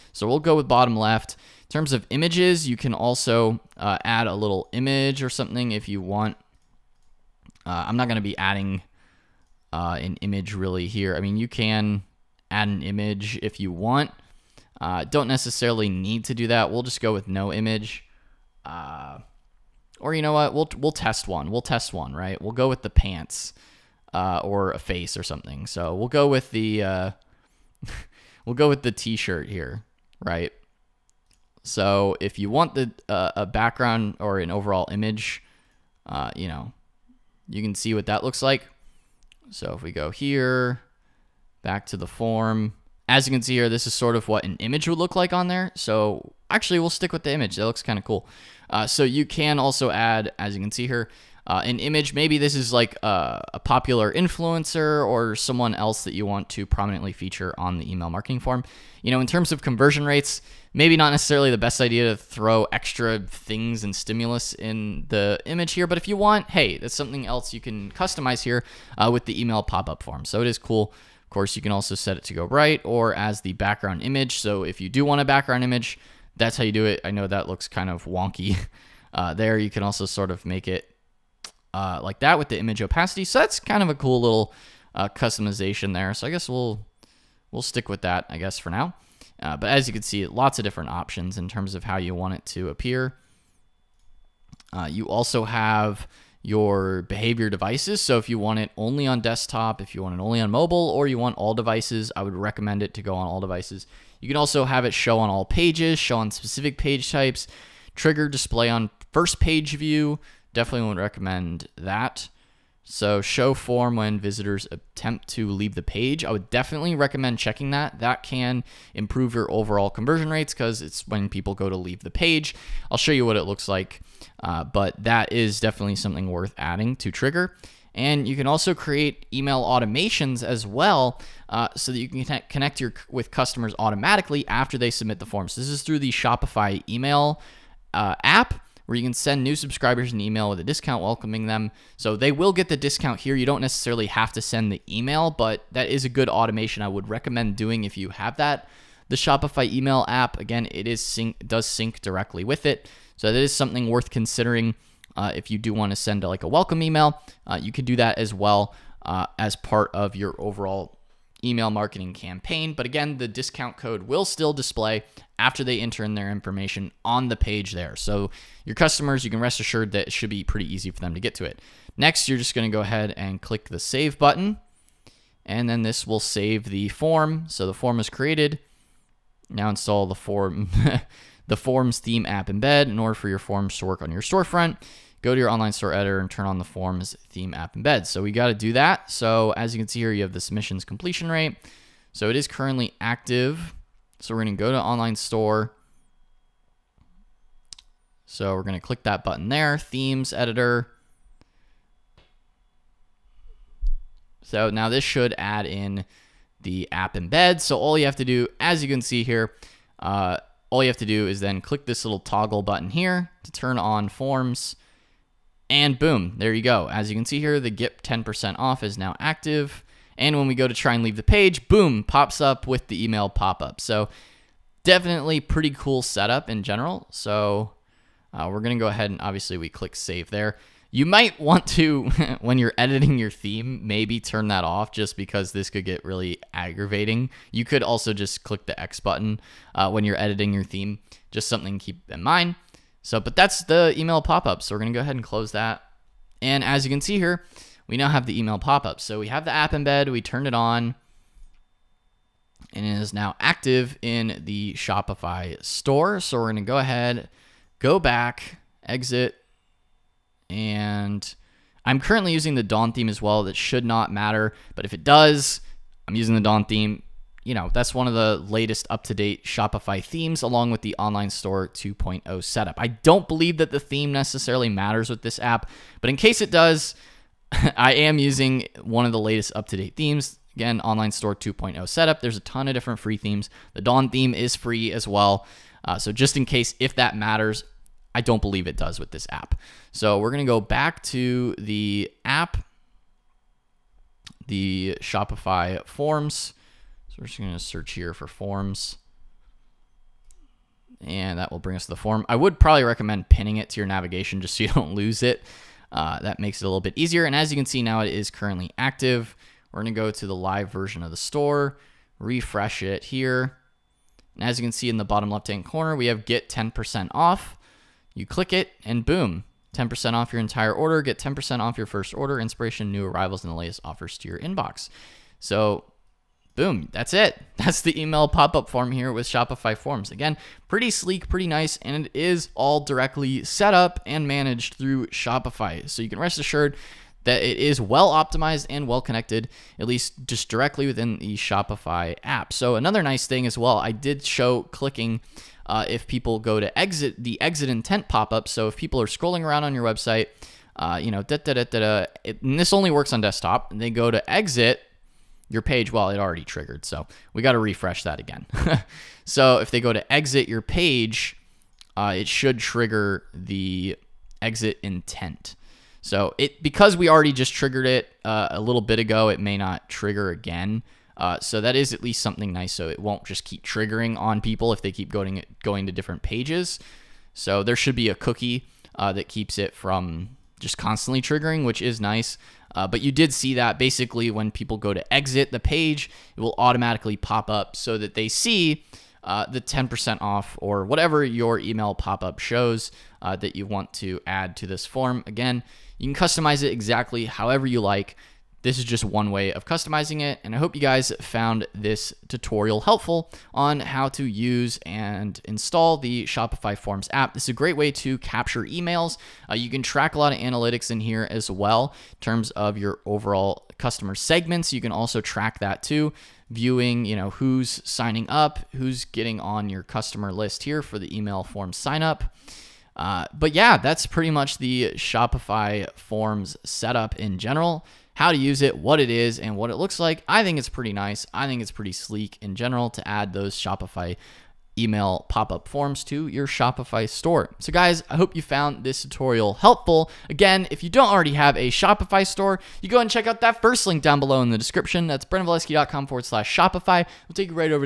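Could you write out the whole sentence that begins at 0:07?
Uh, I'm not going to be adding uh, an image really here.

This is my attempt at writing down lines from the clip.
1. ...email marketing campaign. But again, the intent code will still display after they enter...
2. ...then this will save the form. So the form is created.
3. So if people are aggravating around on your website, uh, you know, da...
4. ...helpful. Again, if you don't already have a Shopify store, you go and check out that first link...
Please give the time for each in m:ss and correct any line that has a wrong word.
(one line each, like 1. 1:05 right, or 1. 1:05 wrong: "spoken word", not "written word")
1. 2:41 wrong: "discount", not "intent"
2. 2:55 right
3. 5:48 wrong: "scrolling", not "aggravating"
4. 7:19 right.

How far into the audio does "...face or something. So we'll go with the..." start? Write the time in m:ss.
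0:24.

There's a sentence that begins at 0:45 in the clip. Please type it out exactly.
So actually, we'll stick with the image.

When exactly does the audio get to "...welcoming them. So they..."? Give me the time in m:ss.
2:21.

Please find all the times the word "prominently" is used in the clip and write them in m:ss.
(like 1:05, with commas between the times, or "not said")
0:56.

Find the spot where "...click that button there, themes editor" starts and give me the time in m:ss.
3:18.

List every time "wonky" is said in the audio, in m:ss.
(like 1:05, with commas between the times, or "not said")
1:18.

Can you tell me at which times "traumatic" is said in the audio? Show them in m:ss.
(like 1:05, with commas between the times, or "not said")
not said.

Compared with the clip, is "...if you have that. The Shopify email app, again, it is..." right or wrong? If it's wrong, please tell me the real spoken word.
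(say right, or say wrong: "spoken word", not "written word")
right.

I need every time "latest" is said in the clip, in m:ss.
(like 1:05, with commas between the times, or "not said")
4:28, 4:39, 5:23.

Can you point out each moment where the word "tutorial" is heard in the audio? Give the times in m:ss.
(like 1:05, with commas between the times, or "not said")
6:42, 7:19.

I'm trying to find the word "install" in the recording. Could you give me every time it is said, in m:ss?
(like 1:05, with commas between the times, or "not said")
2:59, 6:45.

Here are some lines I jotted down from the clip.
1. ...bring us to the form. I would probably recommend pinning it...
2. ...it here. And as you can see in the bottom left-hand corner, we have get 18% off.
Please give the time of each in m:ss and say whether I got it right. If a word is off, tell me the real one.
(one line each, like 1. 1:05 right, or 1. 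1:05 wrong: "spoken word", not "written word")
1. 5:01 right
2. 5:12 wrong: "10", not "18".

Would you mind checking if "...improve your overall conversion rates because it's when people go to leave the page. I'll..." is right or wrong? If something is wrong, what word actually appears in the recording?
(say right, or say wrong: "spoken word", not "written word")
right.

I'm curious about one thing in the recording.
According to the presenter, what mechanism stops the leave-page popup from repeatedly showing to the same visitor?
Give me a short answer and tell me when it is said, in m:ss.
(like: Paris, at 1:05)
A cookie, at 6:18.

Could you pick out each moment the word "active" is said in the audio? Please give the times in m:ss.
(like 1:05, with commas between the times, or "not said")
3:12, 3:39, 4:13, 5:08.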